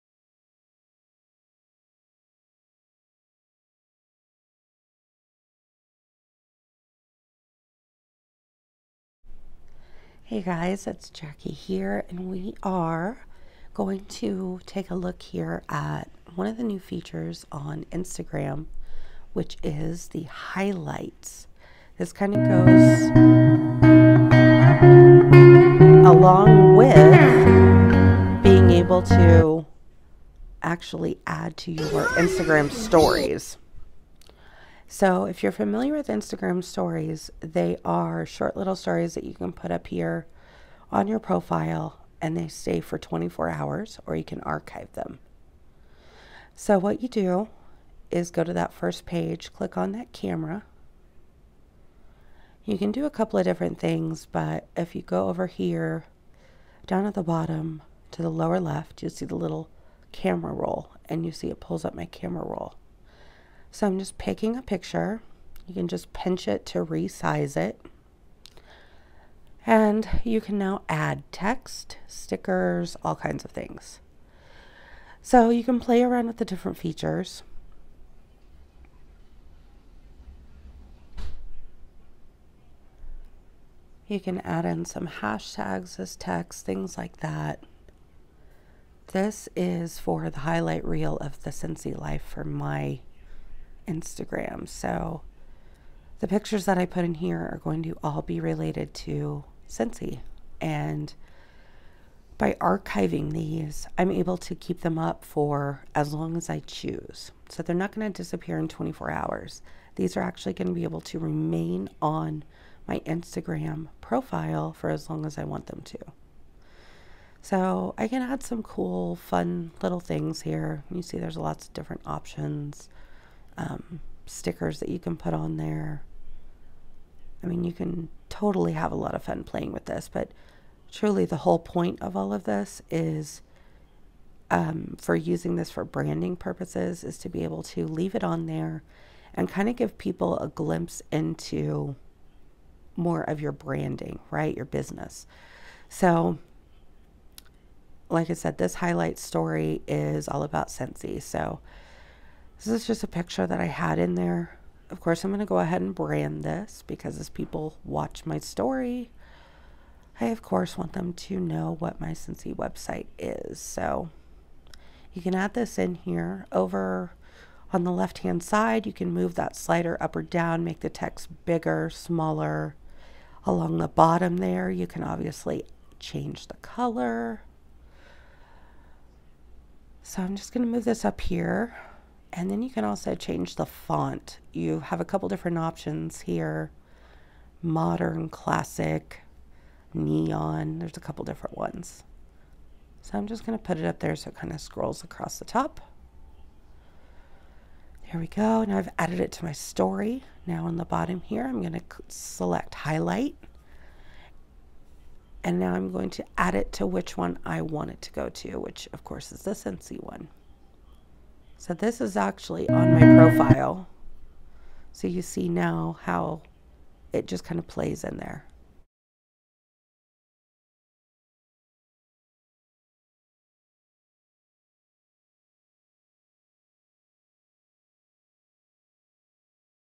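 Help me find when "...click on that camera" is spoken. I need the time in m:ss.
0:49.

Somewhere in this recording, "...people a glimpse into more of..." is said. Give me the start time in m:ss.
2:19.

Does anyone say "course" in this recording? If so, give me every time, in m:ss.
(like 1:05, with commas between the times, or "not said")
2:34, 2:40, 3:29.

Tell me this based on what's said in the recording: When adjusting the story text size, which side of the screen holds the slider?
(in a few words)
left-hand side.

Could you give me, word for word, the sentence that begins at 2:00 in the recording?
You see there's lots of different options um, stickers that you can put on there.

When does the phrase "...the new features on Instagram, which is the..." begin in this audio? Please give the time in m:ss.
0:16.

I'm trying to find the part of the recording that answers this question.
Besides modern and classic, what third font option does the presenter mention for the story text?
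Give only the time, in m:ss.
3:09.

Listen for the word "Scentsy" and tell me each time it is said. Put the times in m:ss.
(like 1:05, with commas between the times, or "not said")
1:31, 1:39, 2:30, 2:42.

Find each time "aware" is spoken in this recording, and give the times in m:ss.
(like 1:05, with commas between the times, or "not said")
not said.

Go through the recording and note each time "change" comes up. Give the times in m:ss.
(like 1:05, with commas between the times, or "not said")
2:55, 3:03.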